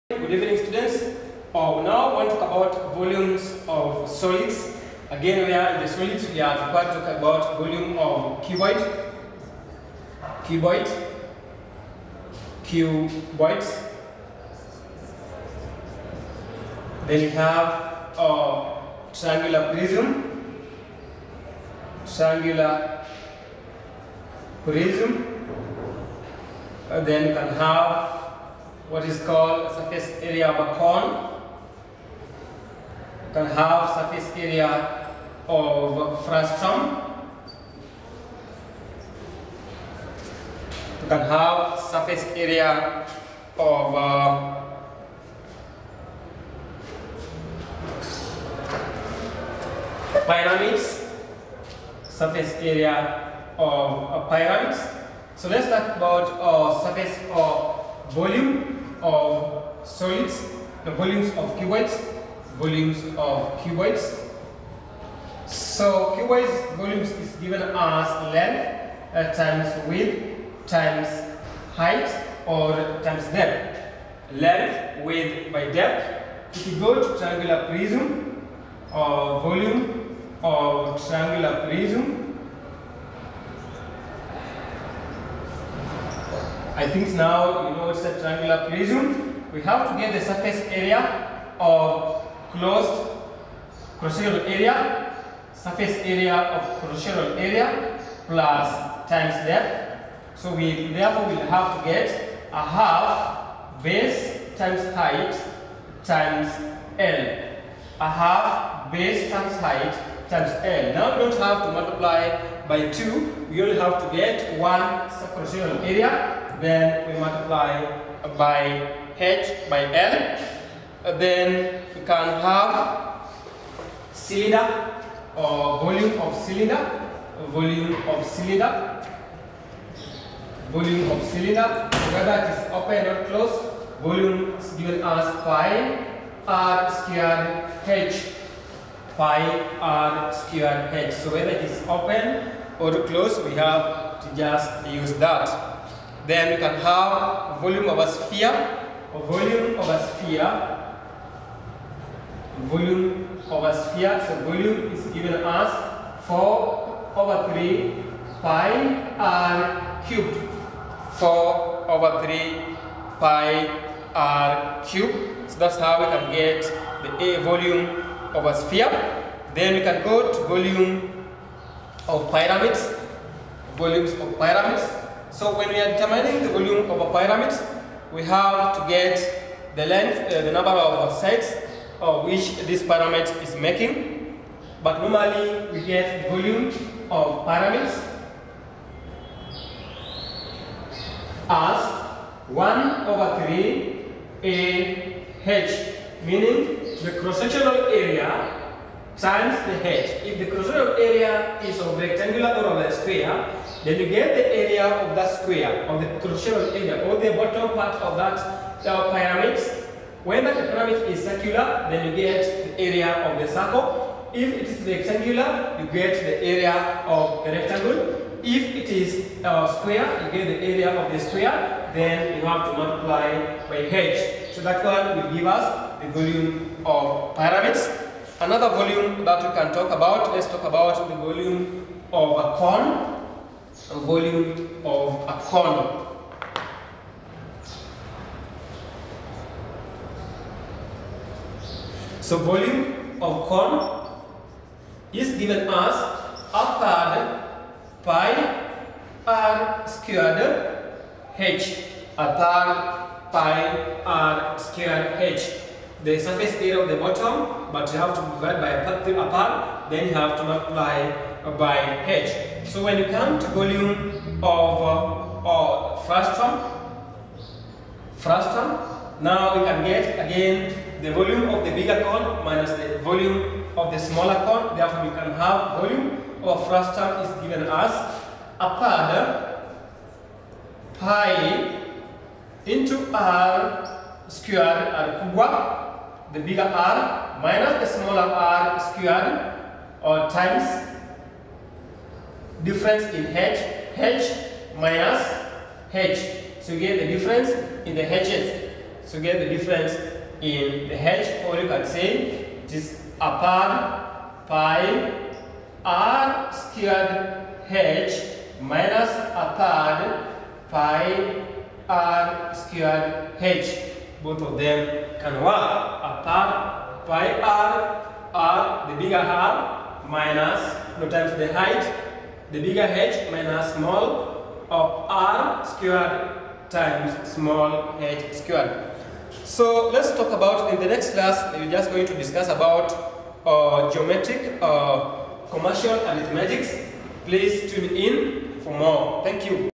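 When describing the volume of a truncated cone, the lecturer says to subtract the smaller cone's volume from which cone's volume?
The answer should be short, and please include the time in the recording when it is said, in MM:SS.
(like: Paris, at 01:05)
the bigger cone, at 04:31.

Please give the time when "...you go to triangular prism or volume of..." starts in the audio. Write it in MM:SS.
01:16.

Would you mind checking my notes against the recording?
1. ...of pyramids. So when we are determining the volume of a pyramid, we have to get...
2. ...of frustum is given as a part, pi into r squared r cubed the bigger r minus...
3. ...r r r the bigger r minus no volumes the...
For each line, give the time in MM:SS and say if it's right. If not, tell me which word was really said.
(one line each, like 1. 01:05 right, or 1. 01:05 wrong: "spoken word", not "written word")
1. 02:54 right
2. 04:36 right
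3. 05:16 wrong: "times", not "volumes".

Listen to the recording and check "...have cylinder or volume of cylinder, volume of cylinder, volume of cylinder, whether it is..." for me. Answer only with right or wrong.
right.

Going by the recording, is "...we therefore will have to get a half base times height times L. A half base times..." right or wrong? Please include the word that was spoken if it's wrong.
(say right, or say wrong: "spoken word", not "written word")
right.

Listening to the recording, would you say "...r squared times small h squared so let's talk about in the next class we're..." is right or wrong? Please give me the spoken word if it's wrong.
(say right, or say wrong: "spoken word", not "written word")
right.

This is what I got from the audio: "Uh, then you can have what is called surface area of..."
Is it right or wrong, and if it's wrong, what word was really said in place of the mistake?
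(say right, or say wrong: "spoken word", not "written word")
right.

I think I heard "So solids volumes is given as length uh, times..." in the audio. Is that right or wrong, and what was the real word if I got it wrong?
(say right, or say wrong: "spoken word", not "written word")
wrong: "cuboids", not "solids".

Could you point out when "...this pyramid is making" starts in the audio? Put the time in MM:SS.
03:02.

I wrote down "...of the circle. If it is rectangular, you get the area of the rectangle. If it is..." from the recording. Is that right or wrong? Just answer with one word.
right.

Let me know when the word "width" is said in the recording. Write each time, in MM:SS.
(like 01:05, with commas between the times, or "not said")
01:09, 01:15.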